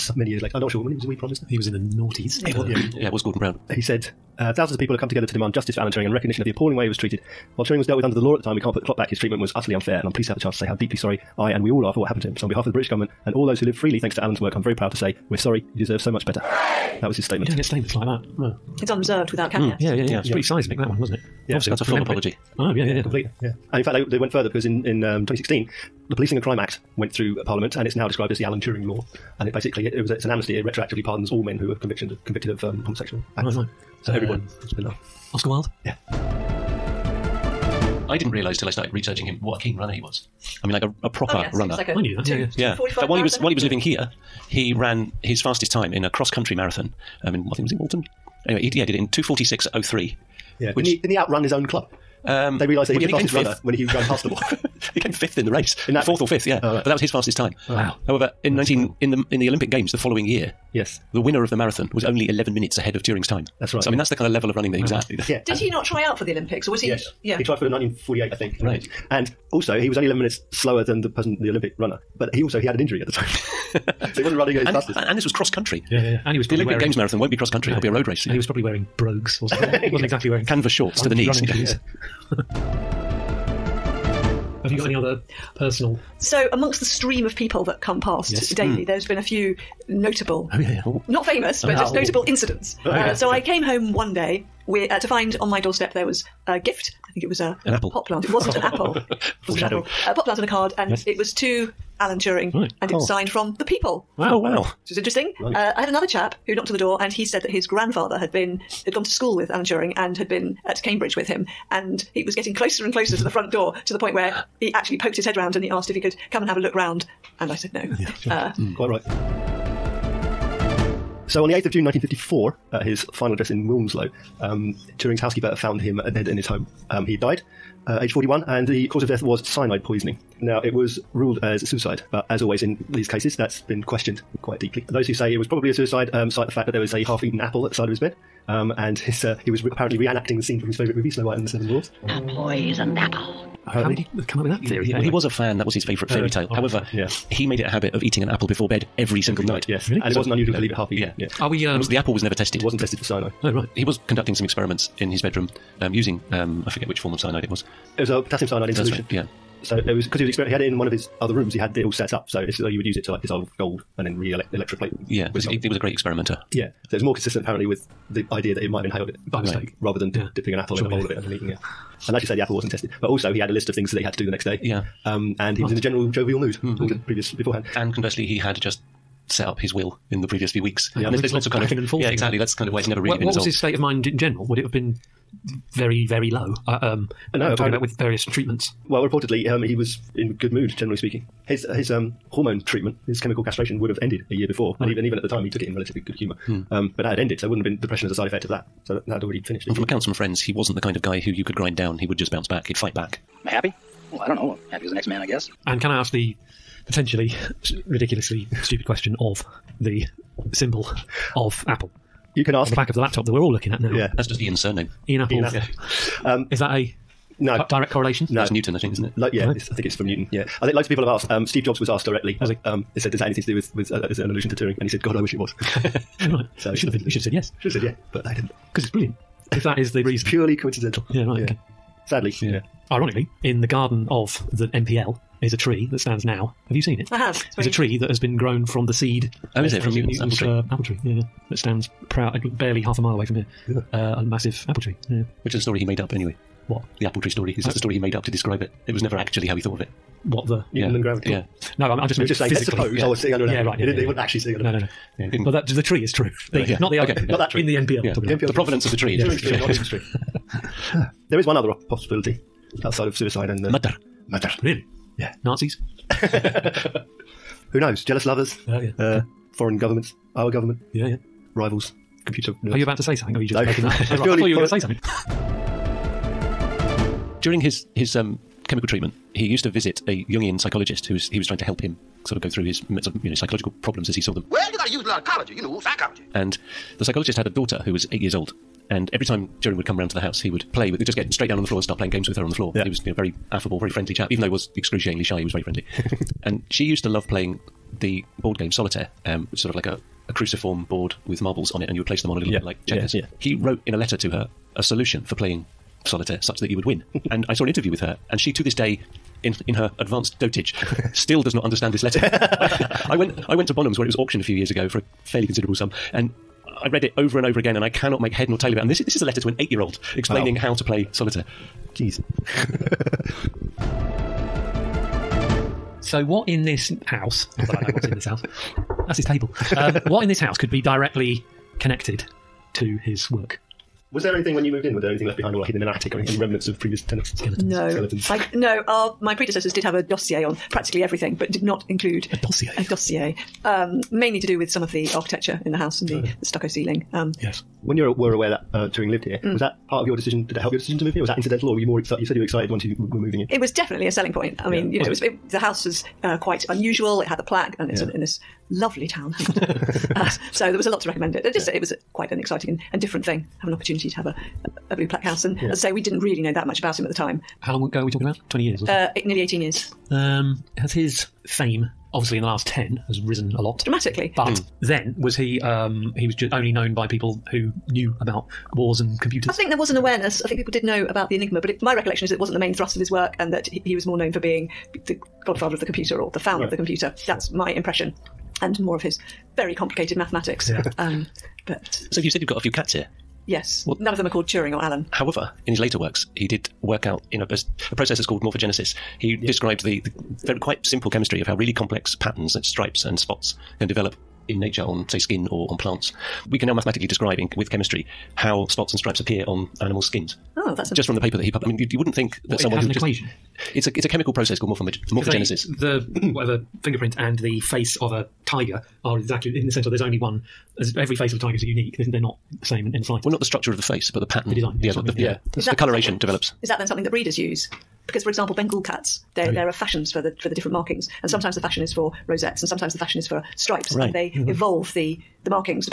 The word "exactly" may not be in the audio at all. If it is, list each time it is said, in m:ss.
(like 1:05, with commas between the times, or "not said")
1:20, 3:02, 6:59.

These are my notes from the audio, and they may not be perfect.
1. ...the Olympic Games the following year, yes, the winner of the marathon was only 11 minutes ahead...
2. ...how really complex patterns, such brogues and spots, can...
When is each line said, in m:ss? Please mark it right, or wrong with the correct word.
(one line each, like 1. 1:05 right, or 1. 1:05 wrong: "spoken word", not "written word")
1. 0:59 right
2. 6:41 wrong: "stripes", not "brogues".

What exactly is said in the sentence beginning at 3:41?
Um, Steve Jobs was asked directly.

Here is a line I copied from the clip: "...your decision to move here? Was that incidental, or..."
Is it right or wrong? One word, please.
right.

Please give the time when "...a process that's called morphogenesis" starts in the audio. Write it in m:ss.
6:37.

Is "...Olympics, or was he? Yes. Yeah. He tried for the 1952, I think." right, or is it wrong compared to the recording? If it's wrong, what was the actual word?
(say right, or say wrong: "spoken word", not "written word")
wrong: "1948", not "1952".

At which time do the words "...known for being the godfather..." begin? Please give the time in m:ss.
6:24.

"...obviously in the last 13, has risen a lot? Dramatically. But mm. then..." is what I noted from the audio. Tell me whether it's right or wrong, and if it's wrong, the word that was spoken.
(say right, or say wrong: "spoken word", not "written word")
wrong: "10", not "13".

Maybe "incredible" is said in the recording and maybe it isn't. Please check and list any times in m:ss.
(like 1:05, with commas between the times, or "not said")
0:58.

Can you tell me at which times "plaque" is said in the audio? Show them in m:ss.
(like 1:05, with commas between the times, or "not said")
5:57, 6:05.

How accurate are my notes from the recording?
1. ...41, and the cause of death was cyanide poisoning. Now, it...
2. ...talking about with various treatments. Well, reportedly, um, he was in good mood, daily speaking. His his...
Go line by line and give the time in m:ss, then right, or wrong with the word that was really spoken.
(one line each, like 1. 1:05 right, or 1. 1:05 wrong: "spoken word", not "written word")
1. 2:08 right
2. 3:07 wrong: "generally", not "daily".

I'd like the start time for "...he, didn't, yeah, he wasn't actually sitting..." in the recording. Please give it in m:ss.
4:13.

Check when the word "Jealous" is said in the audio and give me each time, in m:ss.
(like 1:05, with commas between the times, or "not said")
4:28.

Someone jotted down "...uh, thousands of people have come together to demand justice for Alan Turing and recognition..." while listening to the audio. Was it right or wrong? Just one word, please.
right.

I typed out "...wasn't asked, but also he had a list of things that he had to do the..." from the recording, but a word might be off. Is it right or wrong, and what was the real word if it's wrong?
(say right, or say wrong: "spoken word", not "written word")
wrong: "tested", not "asked".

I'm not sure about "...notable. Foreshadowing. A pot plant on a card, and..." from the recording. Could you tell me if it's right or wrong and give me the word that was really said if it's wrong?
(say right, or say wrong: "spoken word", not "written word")
wrong: "apple", not "notable".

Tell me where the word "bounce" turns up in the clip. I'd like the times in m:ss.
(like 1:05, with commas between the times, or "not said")
3:22.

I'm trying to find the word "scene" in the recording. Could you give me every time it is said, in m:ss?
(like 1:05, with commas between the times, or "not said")
2:20.